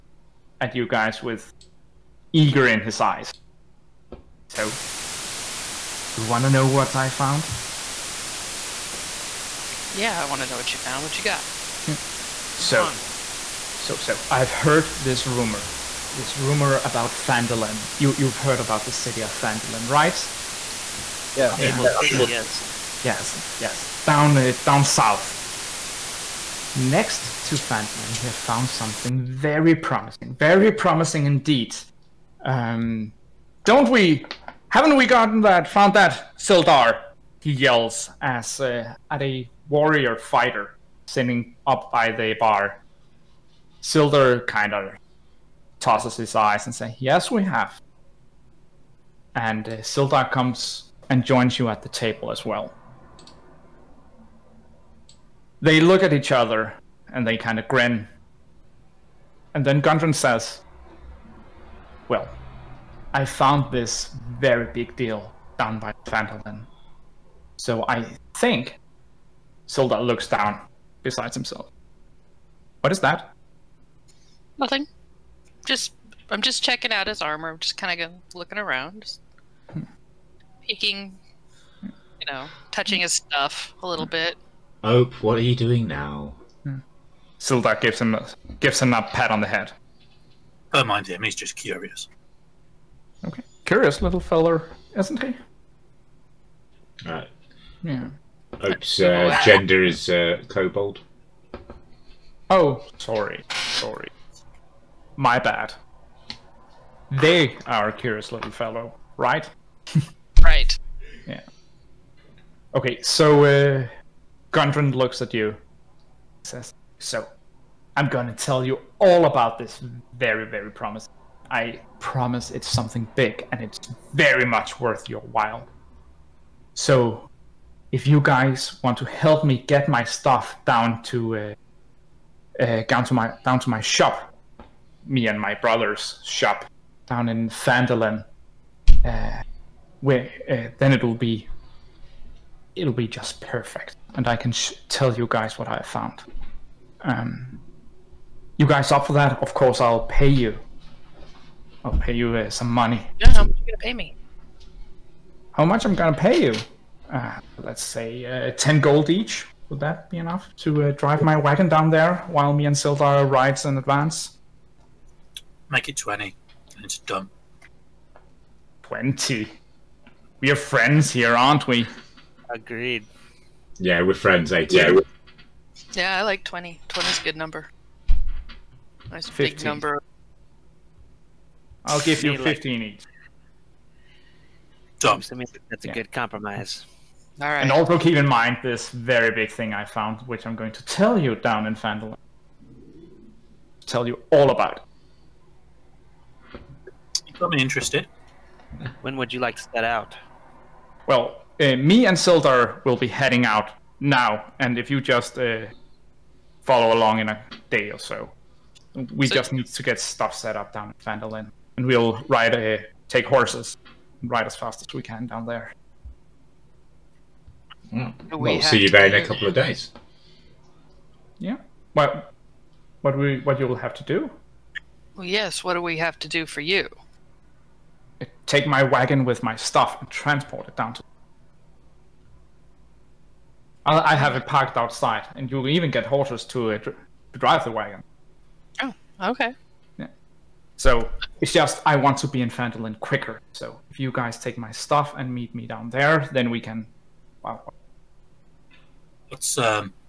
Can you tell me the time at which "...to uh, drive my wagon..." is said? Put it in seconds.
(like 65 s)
160 s.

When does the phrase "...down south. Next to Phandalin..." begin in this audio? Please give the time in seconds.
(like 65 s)
24 s.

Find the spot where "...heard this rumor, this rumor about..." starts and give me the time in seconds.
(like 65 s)
14 s.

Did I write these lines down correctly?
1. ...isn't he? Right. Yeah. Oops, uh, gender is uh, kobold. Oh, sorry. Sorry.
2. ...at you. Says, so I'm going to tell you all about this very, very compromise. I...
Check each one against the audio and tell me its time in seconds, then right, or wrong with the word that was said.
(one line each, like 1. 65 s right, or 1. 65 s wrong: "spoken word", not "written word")
1. 94 s right
2. 115 s wrong: "promise", not "compromise".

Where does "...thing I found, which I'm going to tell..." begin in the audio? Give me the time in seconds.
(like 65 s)
189 s.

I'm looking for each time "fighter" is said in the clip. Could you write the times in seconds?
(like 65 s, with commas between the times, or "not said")
40 s.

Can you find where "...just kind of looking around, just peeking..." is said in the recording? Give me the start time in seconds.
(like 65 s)
77 s.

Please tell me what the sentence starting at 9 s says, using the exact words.
Yeah, I want to know what you found.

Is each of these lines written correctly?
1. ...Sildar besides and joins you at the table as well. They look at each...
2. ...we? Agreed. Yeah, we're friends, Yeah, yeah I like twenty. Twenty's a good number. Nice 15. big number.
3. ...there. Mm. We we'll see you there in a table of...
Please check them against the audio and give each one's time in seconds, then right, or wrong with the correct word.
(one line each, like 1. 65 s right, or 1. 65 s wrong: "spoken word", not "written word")
1. 49 s wrong: "comes", not "besides"
2. 171 s right
3. 215 s wrong: "couple", not "table".